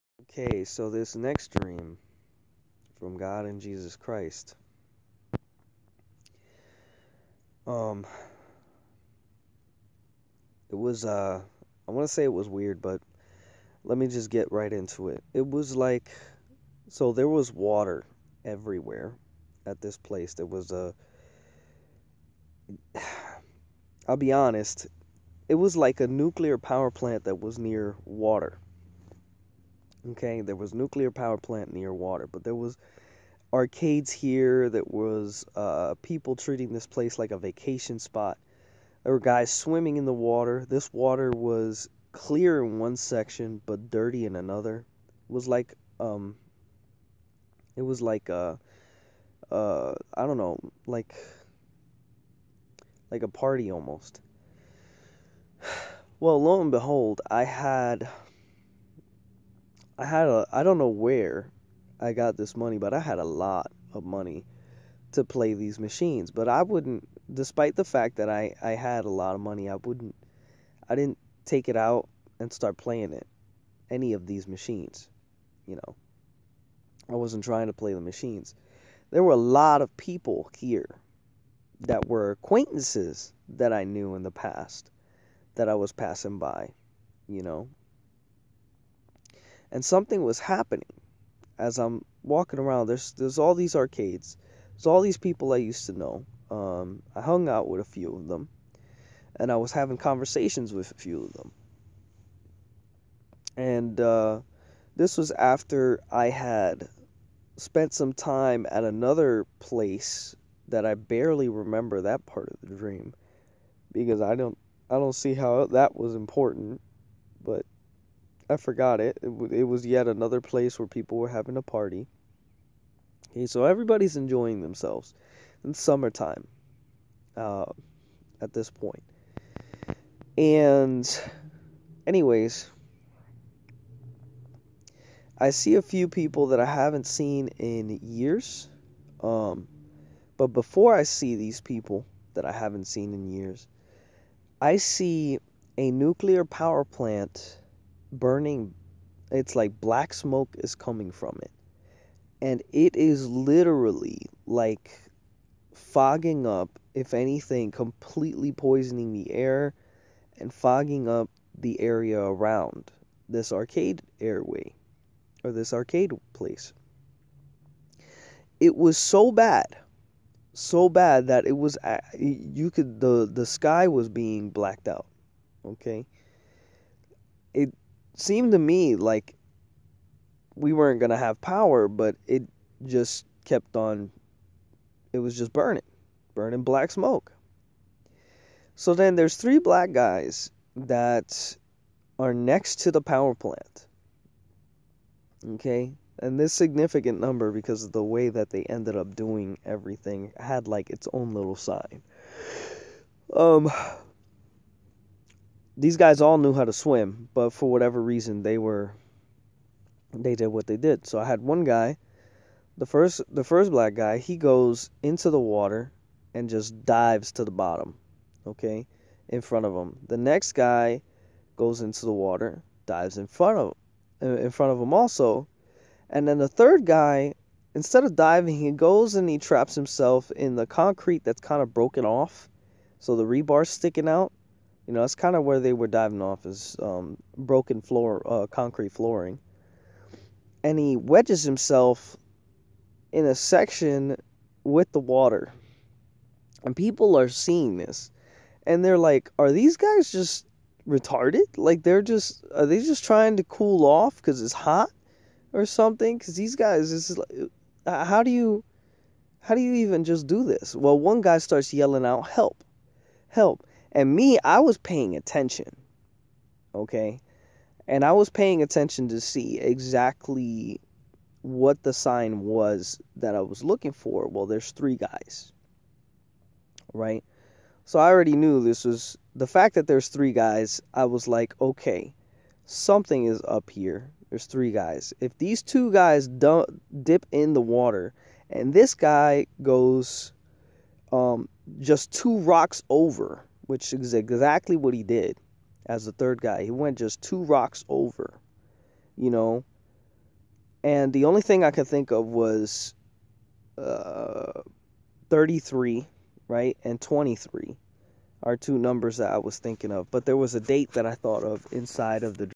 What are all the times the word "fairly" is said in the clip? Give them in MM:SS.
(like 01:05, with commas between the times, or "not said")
not said.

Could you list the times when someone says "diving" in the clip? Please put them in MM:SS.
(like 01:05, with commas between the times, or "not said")
03:48, 03:55.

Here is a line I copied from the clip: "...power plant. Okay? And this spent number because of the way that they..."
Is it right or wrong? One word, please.
wrong.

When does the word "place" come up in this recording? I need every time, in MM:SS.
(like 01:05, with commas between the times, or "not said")
00:19, 00:36, 01:49, 02:00, 02:46.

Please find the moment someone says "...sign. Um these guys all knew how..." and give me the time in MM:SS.
03:21.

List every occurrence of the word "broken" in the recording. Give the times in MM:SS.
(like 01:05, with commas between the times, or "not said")
03:51, 03:57.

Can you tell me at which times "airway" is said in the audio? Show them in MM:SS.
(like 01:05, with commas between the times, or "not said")
02:44.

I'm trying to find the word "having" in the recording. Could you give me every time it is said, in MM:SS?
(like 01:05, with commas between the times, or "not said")
01:39, 02:01.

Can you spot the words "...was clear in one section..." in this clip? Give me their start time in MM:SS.
00:41.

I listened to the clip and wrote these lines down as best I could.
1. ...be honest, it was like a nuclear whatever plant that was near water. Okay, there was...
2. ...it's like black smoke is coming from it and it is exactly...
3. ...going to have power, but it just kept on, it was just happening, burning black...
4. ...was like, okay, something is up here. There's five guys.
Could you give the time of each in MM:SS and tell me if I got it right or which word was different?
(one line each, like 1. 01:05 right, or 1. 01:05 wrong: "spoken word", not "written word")
1. 00:24 wrong: "power", not "whatever"
2. 02:29 wrong: "literally", not "exactly"
3. 03:00 wrong: "burning", not "happening"
4. 04:41 wrong: "three", not "five".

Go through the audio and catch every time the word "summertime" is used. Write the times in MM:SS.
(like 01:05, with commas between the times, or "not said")
02:05.